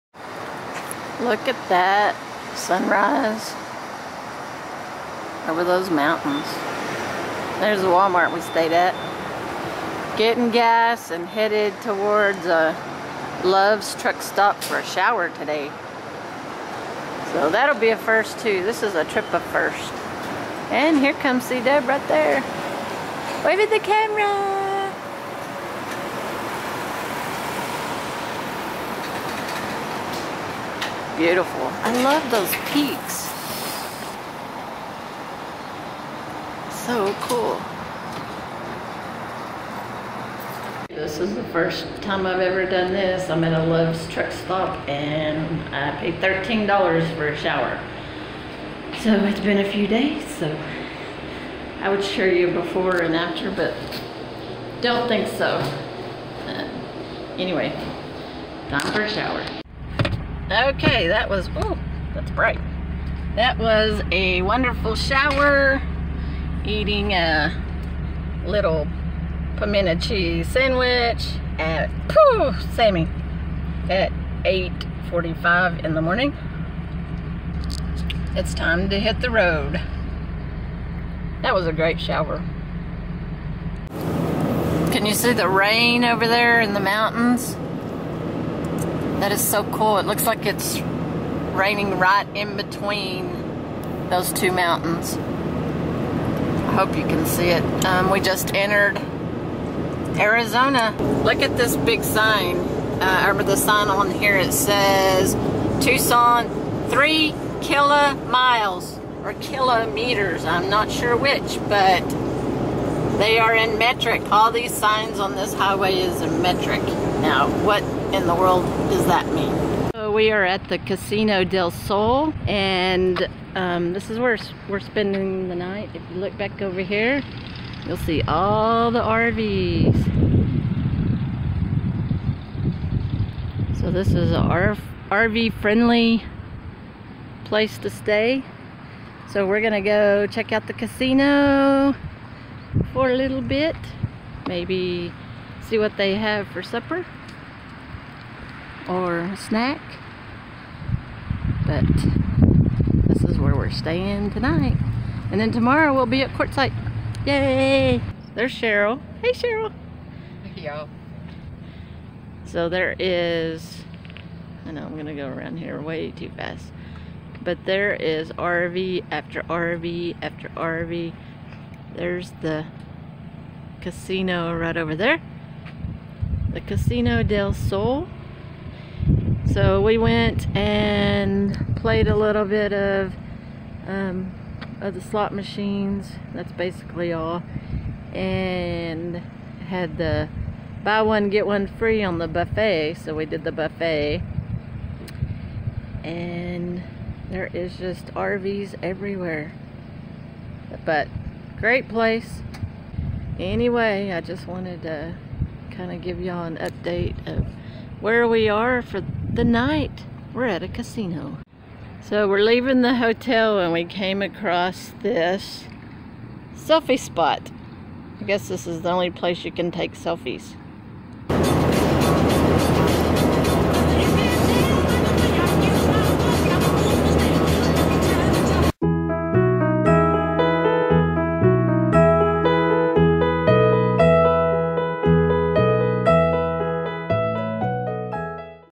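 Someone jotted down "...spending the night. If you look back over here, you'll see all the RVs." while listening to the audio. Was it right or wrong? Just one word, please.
right.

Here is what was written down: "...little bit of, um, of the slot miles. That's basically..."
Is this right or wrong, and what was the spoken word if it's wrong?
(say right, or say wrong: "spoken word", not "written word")
wrong: "machines", not "miles".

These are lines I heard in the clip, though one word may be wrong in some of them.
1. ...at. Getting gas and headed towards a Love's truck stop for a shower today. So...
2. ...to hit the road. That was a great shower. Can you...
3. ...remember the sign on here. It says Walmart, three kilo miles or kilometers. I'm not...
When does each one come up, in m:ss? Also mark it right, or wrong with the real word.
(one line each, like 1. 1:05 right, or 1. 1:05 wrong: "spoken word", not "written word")
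1. 0:08 right
2. 1:18 right
3. 1:43 wrong: "Tucson", not "Walmart".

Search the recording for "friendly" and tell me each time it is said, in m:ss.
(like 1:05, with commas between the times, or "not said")
2:15.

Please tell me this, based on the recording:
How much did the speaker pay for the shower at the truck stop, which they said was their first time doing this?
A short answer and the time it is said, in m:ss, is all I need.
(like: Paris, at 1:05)
$13, at 0:46.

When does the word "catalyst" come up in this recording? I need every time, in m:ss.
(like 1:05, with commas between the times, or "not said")
not said.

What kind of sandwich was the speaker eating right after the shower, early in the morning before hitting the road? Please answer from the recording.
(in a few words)
pimento cheese.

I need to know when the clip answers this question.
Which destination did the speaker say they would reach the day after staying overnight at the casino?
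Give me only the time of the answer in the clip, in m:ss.
2:36.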